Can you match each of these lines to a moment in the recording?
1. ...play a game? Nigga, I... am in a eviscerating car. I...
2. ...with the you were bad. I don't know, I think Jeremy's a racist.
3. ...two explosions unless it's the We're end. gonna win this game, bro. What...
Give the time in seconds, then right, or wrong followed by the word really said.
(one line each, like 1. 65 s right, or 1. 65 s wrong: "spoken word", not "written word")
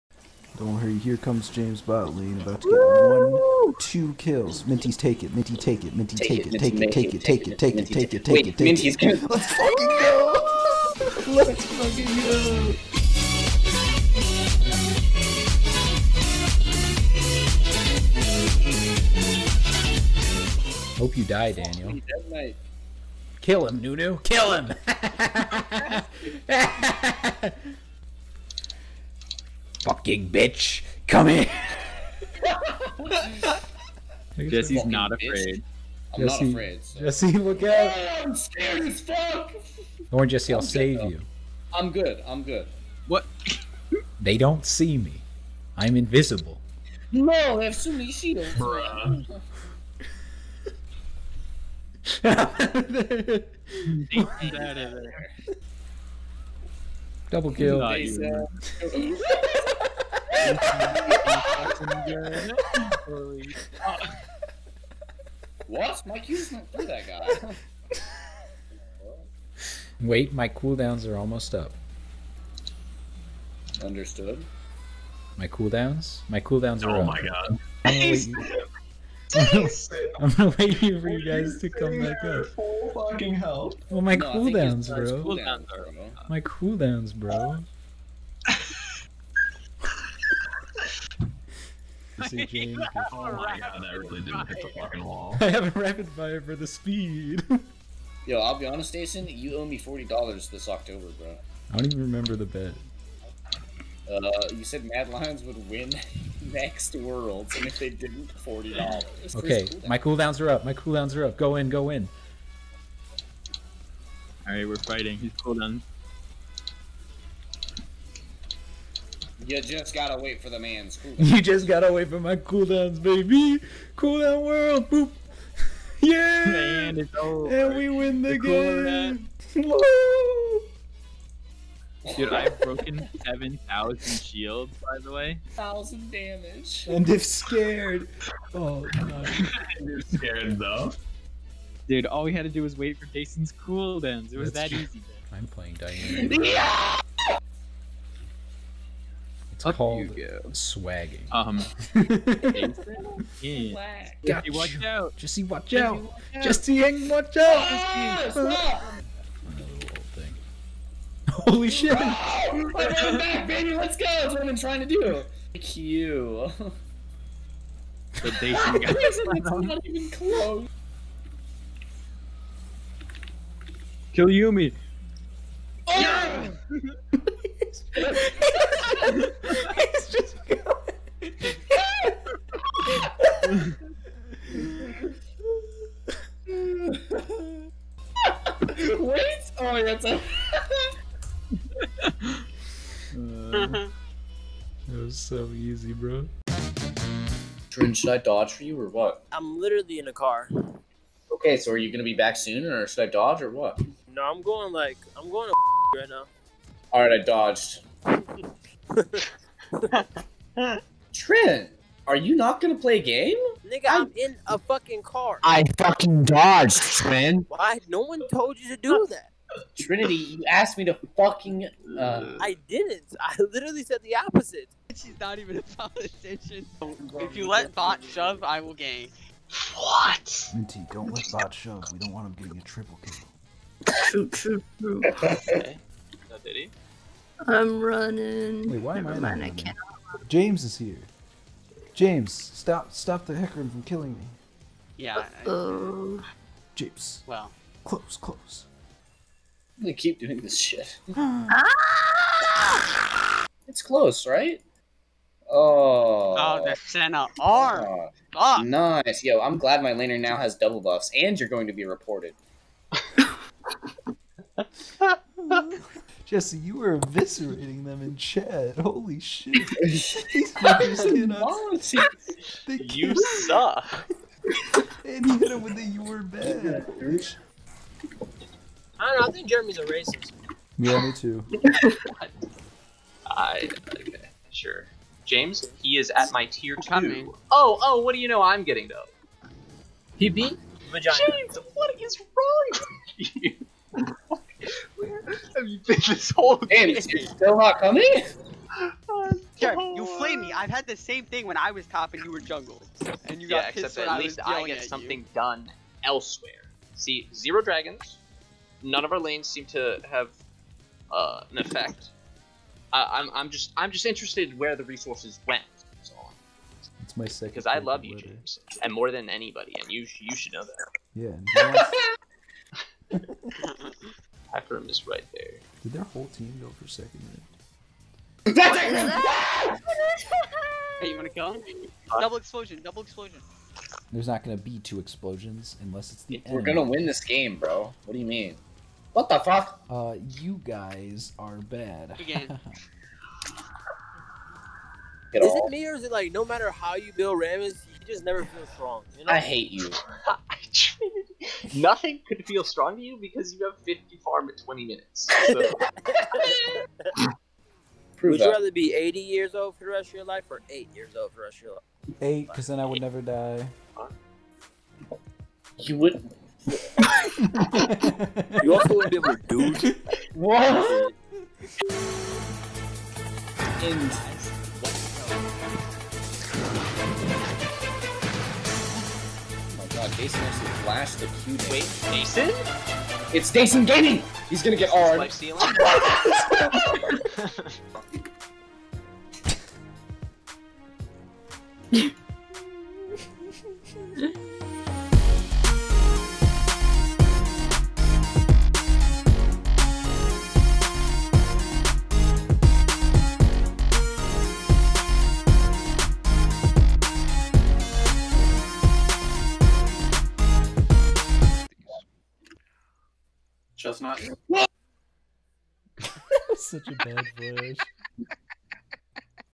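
1. 212 s wrong: "fucking", not "eviscerating"
2. 275 s right
3. 334 s right.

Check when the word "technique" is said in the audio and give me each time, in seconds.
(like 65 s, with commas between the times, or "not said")
not said.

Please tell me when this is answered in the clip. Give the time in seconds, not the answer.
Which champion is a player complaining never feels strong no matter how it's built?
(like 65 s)
347 s.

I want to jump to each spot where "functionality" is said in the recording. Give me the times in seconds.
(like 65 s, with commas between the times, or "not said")
not said.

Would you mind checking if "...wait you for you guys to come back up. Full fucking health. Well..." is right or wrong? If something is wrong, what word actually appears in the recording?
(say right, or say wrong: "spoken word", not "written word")
right.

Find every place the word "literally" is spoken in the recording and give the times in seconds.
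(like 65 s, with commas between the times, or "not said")
199 s, 223 s.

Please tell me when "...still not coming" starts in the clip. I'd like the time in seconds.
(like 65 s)
297 s.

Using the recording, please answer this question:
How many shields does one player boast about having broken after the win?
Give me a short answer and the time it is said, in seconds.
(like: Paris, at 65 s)
7,000, at 133 s.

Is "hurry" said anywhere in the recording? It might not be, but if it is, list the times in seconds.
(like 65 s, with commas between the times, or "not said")
0 s.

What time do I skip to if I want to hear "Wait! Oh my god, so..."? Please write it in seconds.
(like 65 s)
188 s.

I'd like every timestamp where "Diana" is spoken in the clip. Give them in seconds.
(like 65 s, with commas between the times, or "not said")
145 s.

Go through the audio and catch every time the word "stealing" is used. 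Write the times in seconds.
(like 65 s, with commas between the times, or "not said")
385 s.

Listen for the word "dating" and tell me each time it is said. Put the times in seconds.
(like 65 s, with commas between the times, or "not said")
168 s.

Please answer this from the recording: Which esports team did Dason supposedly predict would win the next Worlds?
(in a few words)
Mad Lions.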